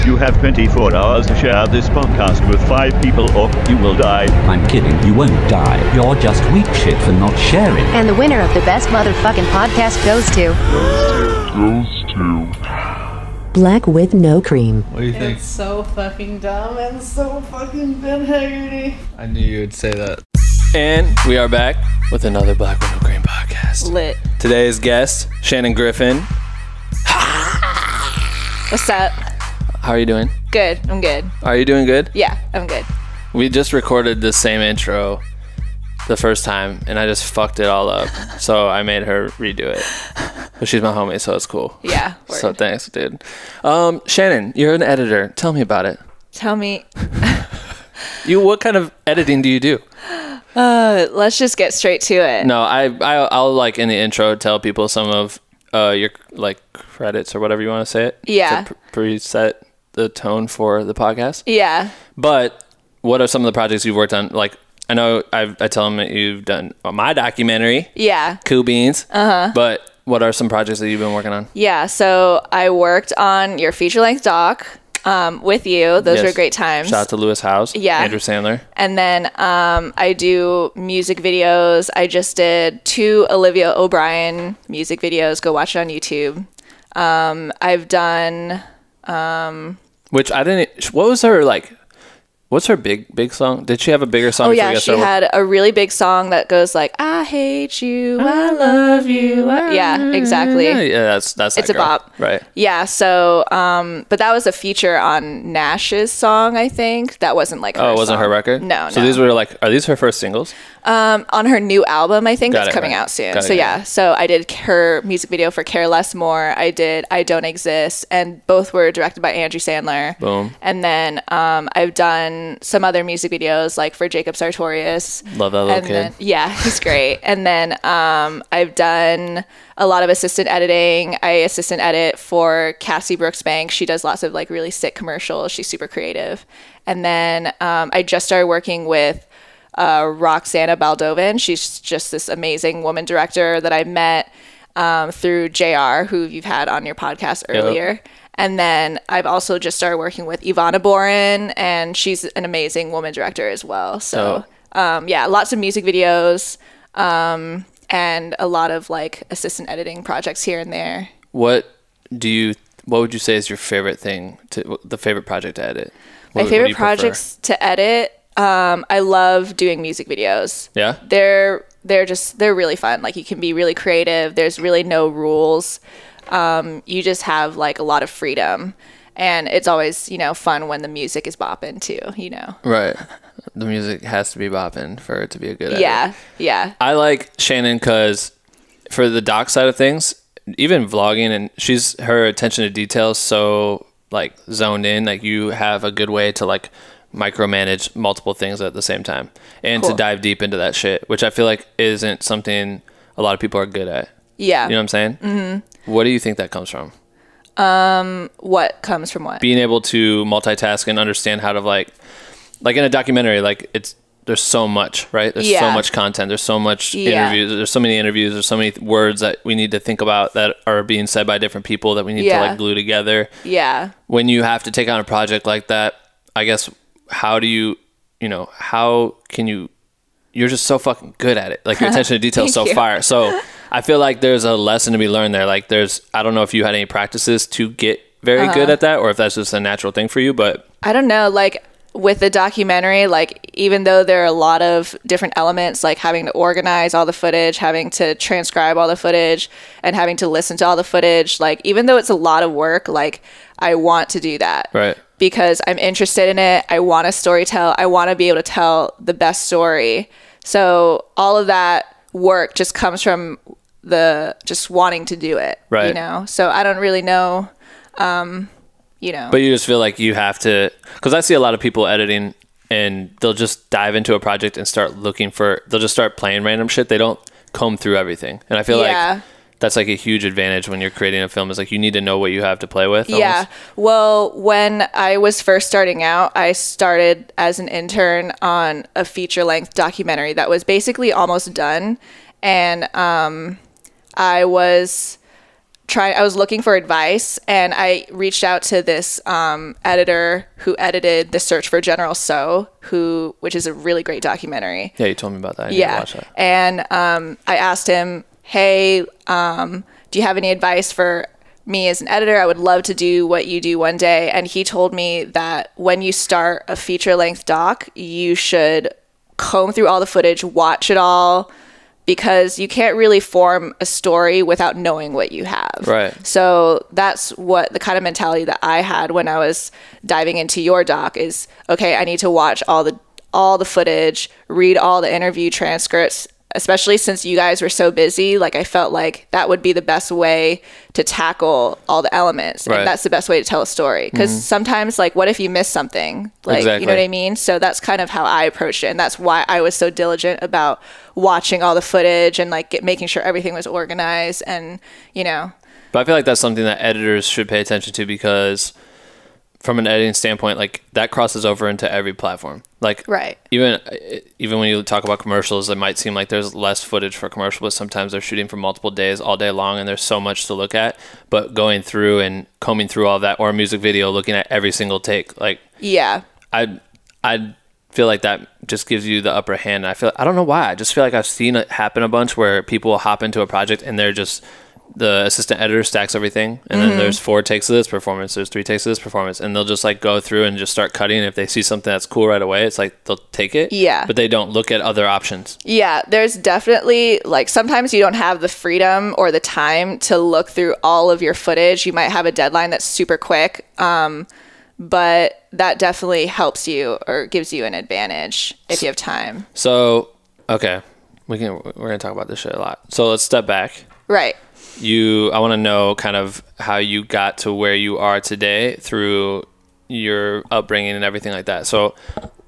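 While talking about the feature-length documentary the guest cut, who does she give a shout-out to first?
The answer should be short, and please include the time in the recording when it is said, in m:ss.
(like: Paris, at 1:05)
Lewis Howes, at 1:17.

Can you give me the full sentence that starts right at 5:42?
and that's the best way to tell a story because mm -hmm.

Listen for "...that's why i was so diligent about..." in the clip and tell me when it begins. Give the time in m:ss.
5:48.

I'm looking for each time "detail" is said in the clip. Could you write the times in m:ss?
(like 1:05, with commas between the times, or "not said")
3:12, 3:52.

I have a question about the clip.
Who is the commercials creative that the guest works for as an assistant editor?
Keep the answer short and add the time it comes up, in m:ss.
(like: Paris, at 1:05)
Cassie Brooks Bank, at 2:12.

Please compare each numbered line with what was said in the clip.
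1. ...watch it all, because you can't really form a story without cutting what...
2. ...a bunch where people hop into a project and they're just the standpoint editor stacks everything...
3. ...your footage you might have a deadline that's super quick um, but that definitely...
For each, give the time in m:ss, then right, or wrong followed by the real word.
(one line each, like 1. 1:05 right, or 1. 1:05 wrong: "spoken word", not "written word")
1. 5:20 wrong: "knowing", not "cutting"
2. 6:22 wrong: "assistant", not "standpoint"
3. 6:41 right.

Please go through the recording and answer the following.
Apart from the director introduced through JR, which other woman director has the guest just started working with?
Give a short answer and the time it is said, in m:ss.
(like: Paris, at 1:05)
Ivana Boren, at 2:30.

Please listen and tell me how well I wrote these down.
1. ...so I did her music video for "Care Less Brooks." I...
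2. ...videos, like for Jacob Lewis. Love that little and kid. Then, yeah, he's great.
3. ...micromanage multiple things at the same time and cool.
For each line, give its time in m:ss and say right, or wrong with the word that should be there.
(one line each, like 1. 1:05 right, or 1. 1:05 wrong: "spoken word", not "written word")
1. 1:53 wrong: "More", not "Brooks"
2. 2:03 wrong: "Sartorius", not "Lewis"
3. 3:17 right.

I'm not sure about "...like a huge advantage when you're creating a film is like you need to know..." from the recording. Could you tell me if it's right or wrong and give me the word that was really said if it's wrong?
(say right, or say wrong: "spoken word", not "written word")
right.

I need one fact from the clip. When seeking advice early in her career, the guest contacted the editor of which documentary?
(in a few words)
The Search for General Tso.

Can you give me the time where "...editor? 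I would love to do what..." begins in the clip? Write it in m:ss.
5:12.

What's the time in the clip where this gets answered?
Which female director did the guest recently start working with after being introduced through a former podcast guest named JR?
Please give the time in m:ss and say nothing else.
2:20.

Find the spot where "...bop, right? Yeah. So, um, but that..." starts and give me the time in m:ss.
1:41.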